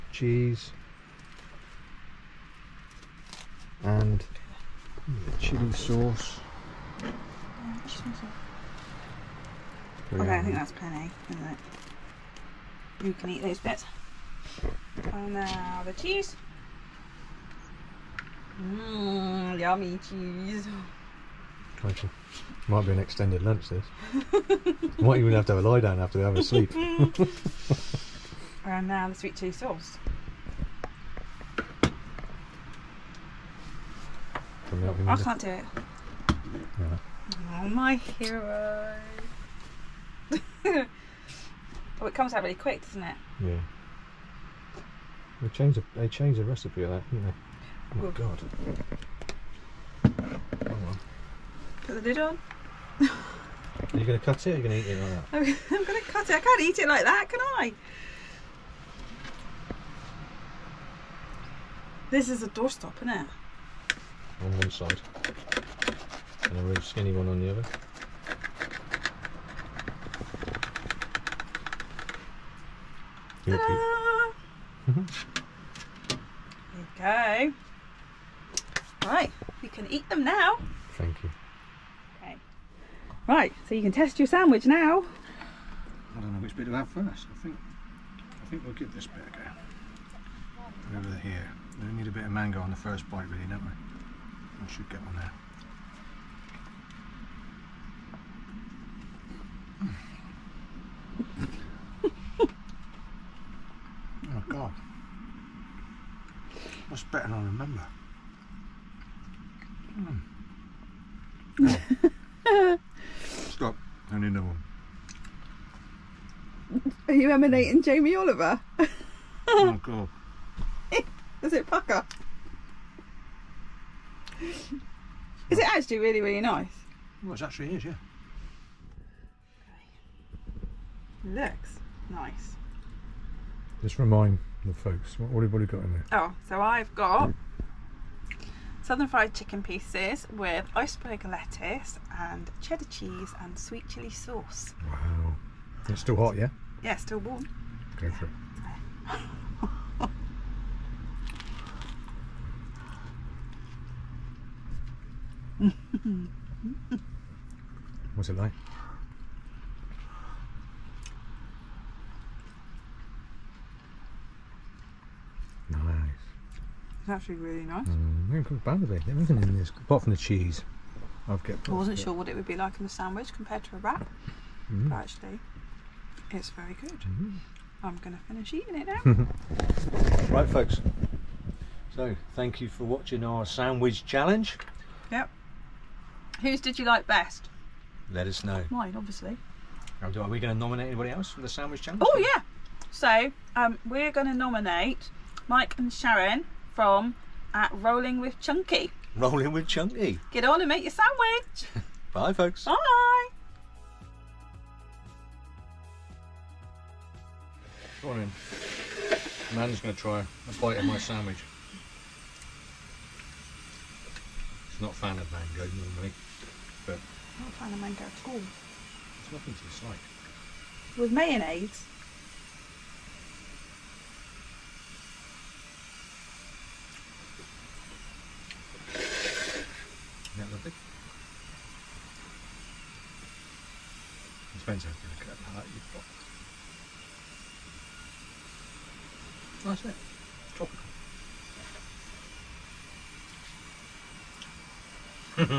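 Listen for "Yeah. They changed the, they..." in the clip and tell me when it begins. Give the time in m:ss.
0:43.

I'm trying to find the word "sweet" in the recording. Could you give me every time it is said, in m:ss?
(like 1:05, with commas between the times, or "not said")
0:29, 2:23.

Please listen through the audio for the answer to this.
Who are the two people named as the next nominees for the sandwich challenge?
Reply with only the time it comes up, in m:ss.
3:15.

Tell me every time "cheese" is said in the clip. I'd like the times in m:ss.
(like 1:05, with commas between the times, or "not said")
0:00, 0:15, 0:20, 0:29, 2:22, 2:50.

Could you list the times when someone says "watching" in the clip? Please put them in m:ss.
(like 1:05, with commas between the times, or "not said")
3:02.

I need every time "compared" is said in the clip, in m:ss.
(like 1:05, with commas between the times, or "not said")
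2:53.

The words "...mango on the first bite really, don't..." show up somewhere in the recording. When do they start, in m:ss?
1:32.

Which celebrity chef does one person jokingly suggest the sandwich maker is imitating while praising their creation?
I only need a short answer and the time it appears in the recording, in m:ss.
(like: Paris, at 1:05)
Jamie Oliver, at 1:57.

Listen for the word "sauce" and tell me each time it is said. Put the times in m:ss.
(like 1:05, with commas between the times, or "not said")
0:05, 0:29, 2:24.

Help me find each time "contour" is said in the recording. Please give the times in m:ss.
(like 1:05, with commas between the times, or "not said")
not said.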